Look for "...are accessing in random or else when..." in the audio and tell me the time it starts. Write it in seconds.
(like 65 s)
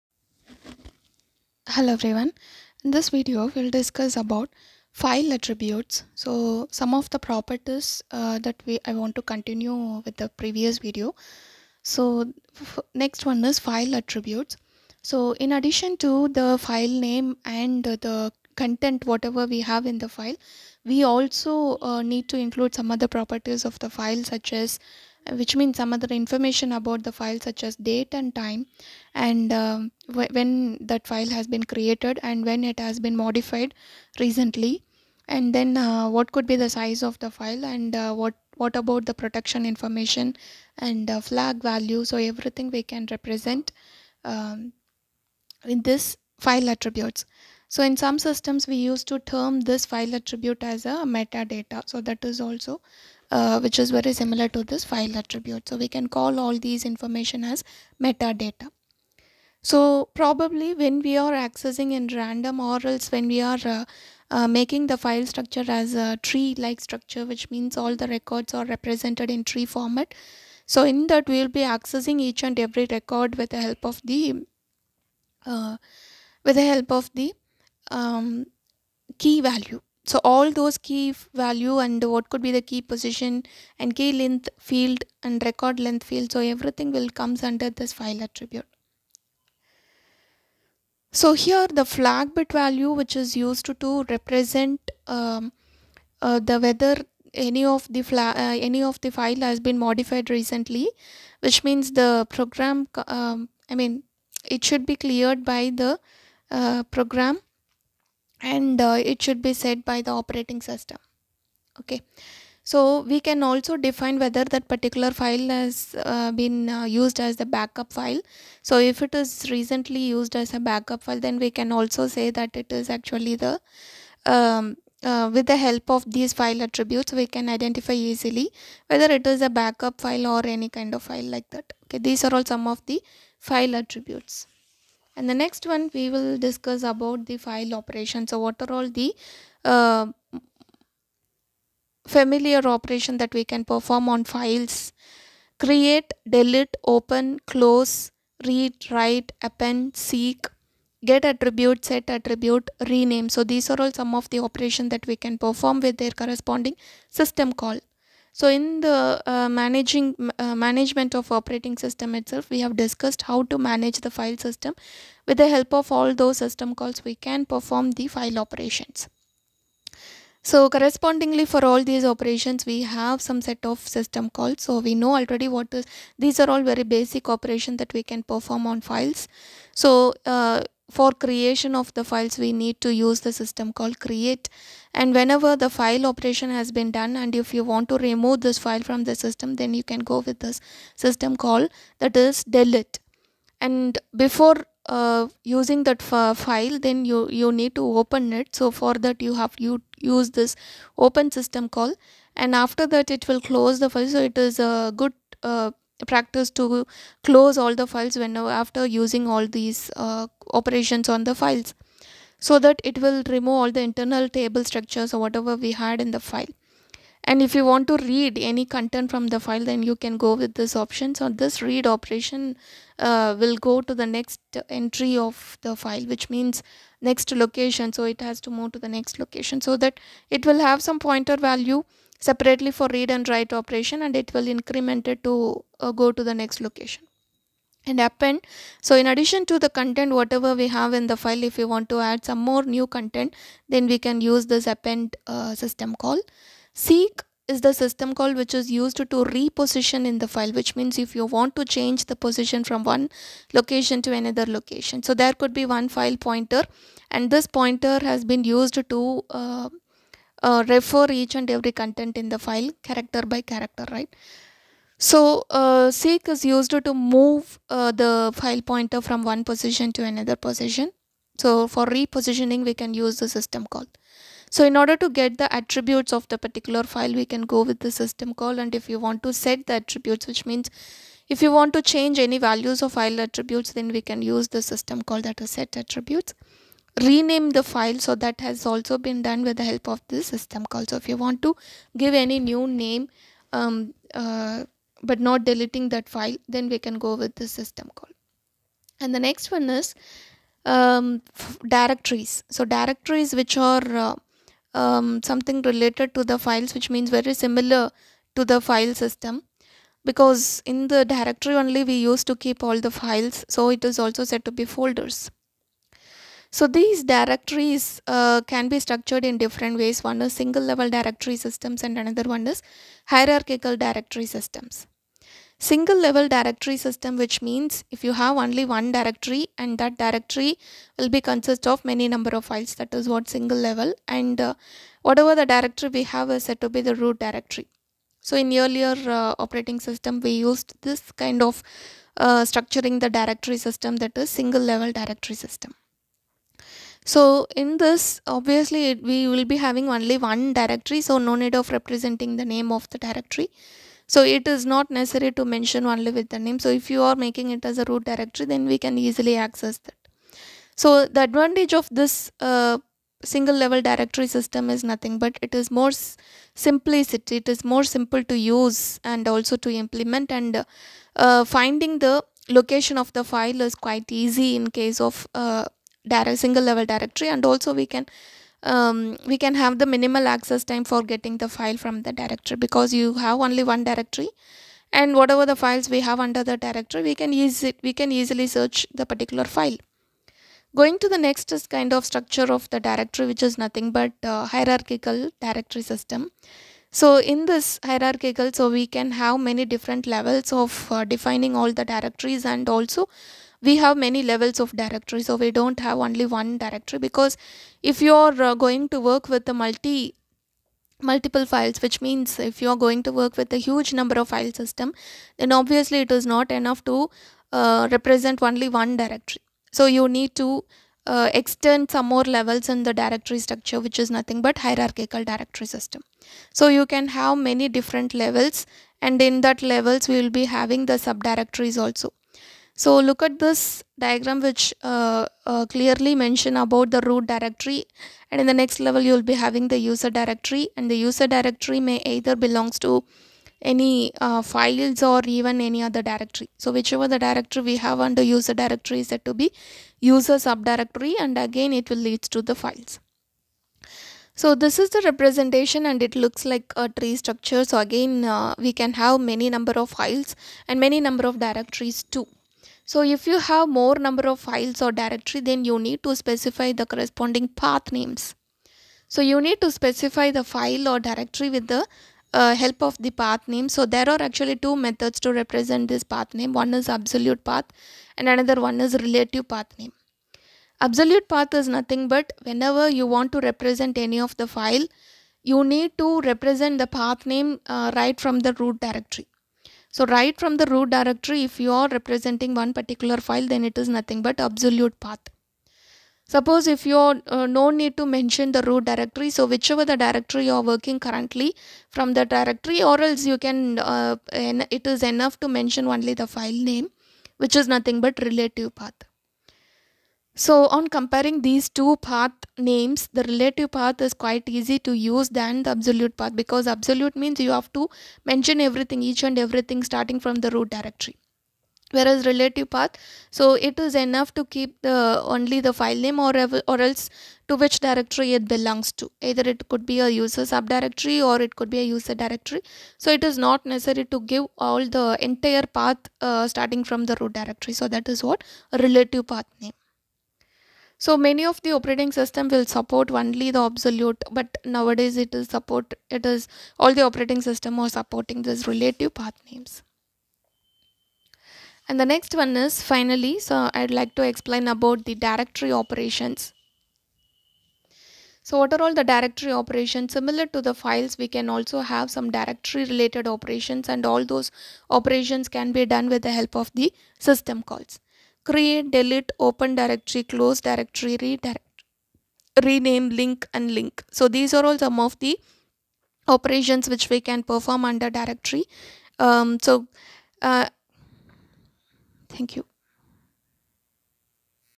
61 s.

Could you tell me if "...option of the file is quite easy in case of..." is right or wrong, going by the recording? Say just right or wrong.
wrong.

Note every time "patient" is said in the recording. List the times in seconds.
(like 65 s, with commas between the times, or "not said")
not said.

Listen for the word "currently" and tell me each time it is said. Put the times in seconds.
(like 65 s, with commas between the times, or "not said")
500 s.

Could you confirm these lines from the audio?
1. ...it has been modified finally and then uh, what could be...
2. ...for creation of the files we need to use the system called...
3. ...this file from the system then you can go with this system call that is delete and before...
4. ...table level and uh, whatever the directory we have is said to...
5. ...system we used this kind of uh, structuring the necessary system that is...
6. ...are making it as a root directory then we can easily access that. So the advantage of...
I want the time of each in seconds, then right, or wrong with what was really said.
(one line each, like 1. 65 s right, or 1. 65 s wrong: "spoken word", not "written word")
1. 32 s wrong: "recently", not "finally"
2. 180 s right
3. 188 s right
4. 333 s wrong: "single", not "table"
5. 339 s wrong: "directory", not "necessary"
6. 357 s right.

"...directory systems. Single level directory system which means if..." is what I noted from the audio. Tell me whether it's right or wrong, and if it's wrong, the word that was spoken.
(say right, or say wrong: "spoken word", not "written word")
right.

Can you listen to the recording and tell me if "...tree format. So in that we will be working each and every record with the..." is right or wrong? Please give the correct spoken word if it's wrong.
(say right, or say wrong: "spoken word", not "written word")
wrong: "accessing", not "working".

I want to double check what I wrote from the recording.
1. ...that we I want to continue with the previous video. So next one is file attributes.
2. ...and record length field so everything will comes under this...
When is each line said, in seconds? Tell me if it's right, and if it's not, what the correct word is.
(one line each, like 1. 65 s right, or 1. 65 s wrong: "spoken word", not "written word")
1. 8 s right
2. 85 s right.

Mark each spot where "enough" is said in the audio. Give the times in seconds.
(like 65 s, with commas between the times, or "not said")
416 s, 505 s, 523 s.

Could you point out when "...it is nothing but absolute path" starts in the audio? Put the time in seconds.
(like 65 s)
493 s.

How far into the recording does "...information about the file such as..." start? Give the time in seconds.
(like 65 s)
26 s.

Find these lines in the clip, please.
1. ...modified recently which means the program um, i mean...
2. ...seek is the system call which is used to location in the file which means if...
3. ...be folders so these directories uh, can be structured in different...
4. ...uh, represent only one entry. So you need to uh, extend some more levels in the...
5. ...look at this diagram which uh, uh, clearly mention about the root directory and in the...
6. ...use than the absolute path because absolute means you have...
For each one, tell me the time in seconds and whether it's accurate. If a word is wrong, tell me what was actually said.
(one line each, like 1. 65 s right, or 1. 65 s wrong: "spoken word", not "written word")
1. 99 s right
2. 246 s wrong: "reposition", not "location"
3. 314 s right
4. 417 s wrong: "directory", not "entry"
5. 432 s right
6. 514 s right.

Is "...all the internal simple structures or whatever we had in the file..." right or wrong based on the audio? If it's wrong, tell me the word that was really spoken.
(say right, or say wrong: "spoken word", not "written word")
wrong: "table", not "simple".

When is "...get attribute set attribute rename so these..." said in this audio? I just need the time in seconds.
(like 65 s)
151 s.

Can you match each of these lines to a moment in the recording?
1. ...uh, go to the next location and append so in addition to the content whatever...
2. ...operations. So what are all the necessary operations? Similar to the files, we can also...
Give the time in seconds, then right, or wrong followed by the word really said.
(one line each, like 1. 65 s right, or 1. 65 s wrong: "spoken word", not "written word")
1. 235 s right
2. 555 s wrong: "directory", not "necessary".